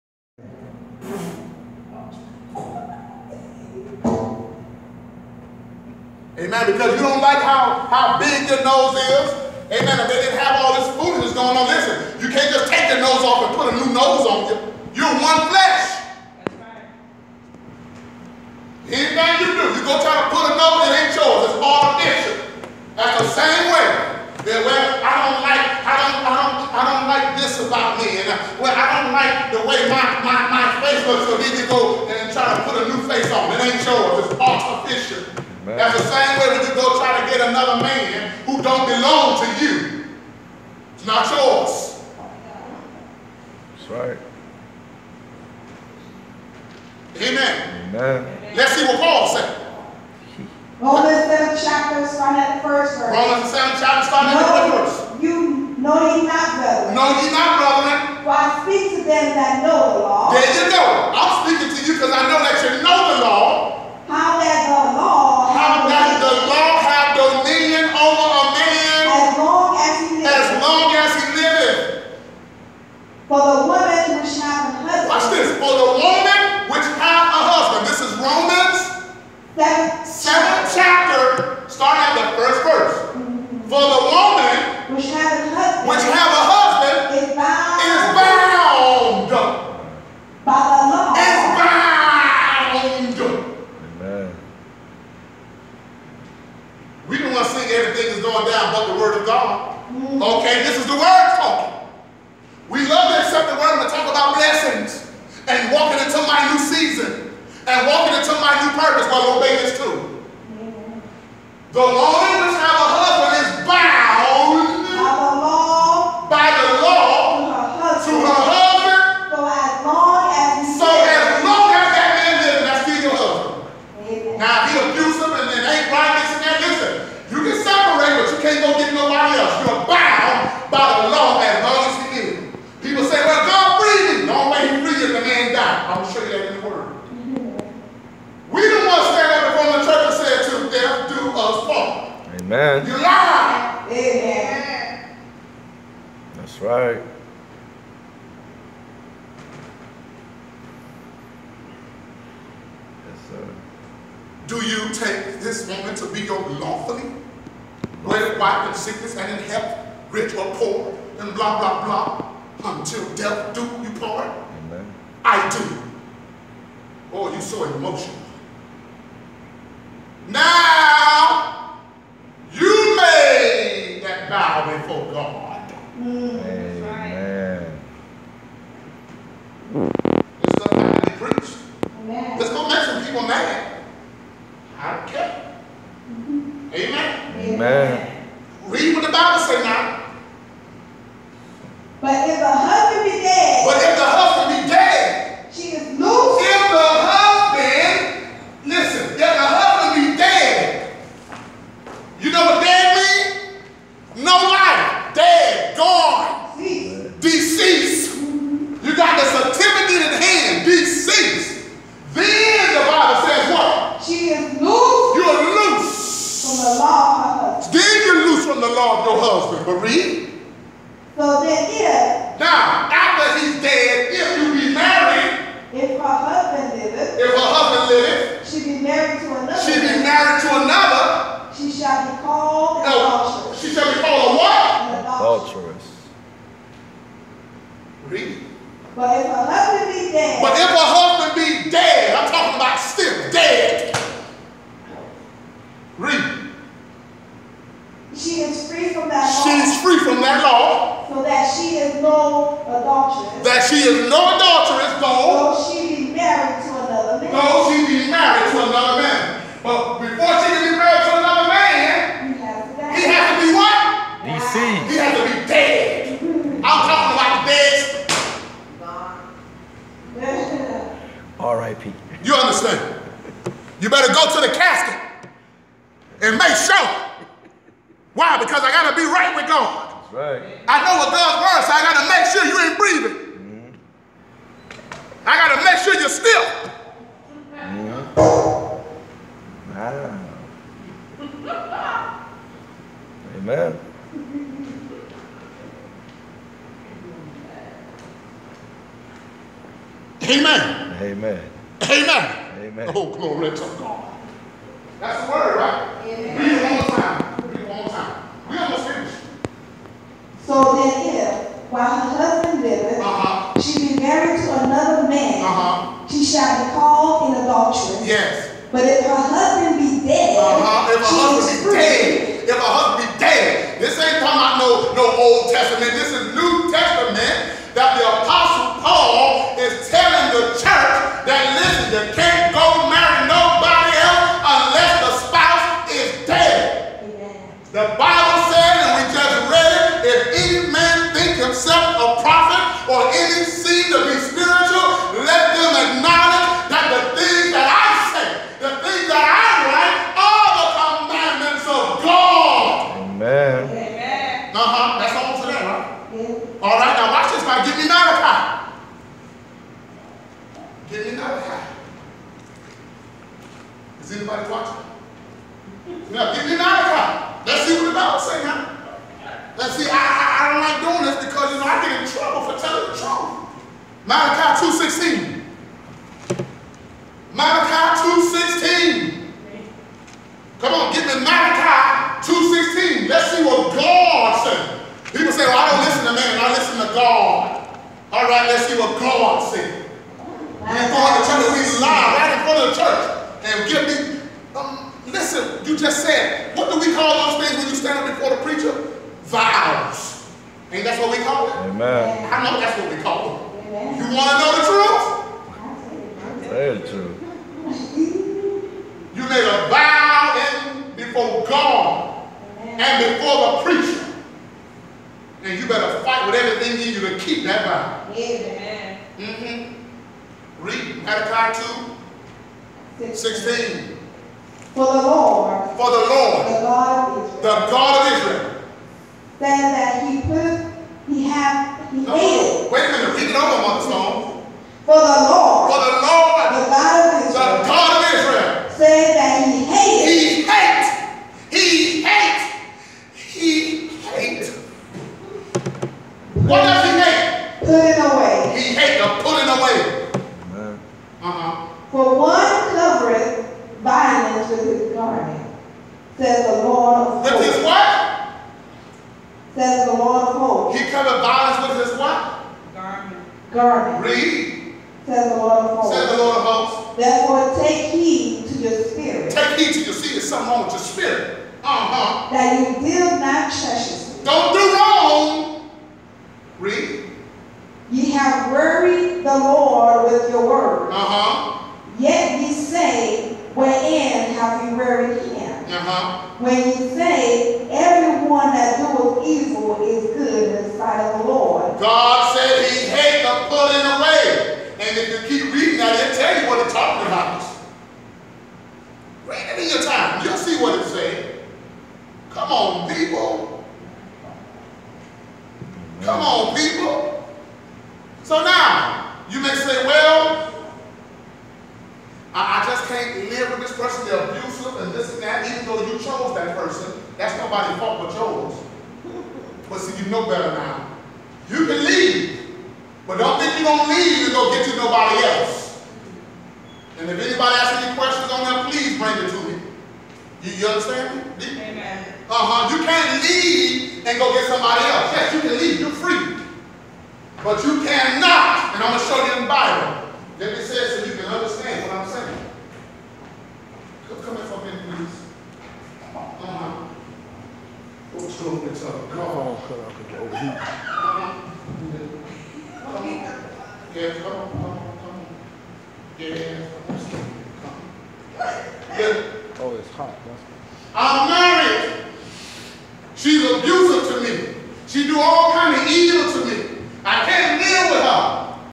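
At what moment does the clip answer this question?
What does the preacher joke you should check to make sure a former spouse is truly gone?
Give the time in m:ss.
4:34.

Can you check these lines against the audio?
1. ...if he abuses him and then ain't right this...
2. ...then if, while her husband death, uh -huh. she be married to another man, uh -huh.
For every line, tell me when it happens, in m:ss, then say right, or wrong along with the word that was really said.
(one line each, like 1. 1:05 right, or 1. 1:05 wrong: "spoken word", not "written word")
1. 2:04 right
2. 5:10 wrong: "liveth", not "death".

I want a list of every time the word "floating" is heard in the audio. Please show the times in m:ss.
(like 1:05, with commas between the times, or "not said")
not said.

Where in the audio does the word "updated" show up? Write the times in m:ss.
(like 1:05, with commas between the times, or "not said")
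not said.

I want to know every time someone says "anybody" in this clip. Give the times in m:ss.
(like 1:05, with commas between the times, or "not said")
6:04, 8:47.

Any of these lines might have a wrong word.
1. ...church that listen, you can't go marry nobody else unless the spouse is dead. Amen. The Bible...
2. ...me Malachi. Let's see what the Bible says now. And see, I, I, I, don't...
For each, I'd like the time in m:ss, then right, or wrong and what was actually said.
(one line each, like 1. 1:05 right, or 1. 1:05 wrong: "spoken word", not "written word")
1. 5:30 right
2. 6:06 right.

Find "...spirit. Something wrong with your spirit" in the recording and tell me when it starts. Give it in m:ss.
7:49.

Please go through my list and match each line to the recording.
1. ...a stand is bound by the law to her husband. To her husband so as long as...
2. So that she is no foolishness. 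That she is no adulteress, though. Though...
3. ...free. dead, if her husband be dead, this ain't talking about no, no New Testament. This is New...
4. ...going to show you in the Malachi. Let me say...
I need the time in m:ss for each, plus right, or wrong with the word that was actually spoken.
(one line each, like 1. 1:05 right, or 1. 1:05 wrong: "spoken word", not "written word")
1. 1:52 wrong: "husband", not "stand"
2. 4:11 wrong: "adulteress", not "foolishness"
3. 5:21 wrong: "Old", not "New"
4. 8:58 wrong: "Bible", not "Malachi".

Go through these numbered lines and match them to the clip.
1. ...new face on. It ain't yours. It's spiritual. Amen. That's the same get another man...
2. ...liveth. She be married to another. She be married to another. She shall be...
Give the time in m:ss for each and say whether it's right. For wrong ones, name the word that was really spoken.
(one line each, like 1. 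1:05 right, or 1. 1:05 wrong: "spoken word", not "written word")
1. 0:32 wrong: "artificial", not "spiritual"
2. 3:47 right.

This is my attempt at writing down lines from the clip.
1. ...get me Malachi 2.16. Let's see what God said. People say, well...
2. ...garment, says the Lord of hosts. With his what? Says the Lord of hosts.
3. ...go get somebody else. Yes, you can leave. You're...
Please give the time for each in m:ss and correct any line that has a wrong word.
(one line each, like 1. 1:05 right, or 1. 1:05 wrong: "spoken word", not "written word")
1. 6:20 right
2. 7:34 right
3. 8:54 right.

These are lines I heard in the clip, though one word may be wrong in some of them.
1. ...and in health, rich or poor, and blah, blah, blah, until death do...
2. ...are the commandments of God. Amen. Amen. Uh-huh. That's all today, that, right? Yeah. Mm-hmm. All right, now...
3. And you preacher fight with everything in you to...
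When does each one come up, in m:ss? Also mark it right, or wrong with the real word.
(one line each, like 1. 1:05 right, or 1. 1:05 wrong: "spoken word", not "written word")
1. 2:39 right
2. 5:50 right
3. 6:55 wrong: "better", not "preacher".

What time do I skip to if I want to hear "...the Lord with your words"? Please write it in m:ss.
7:59.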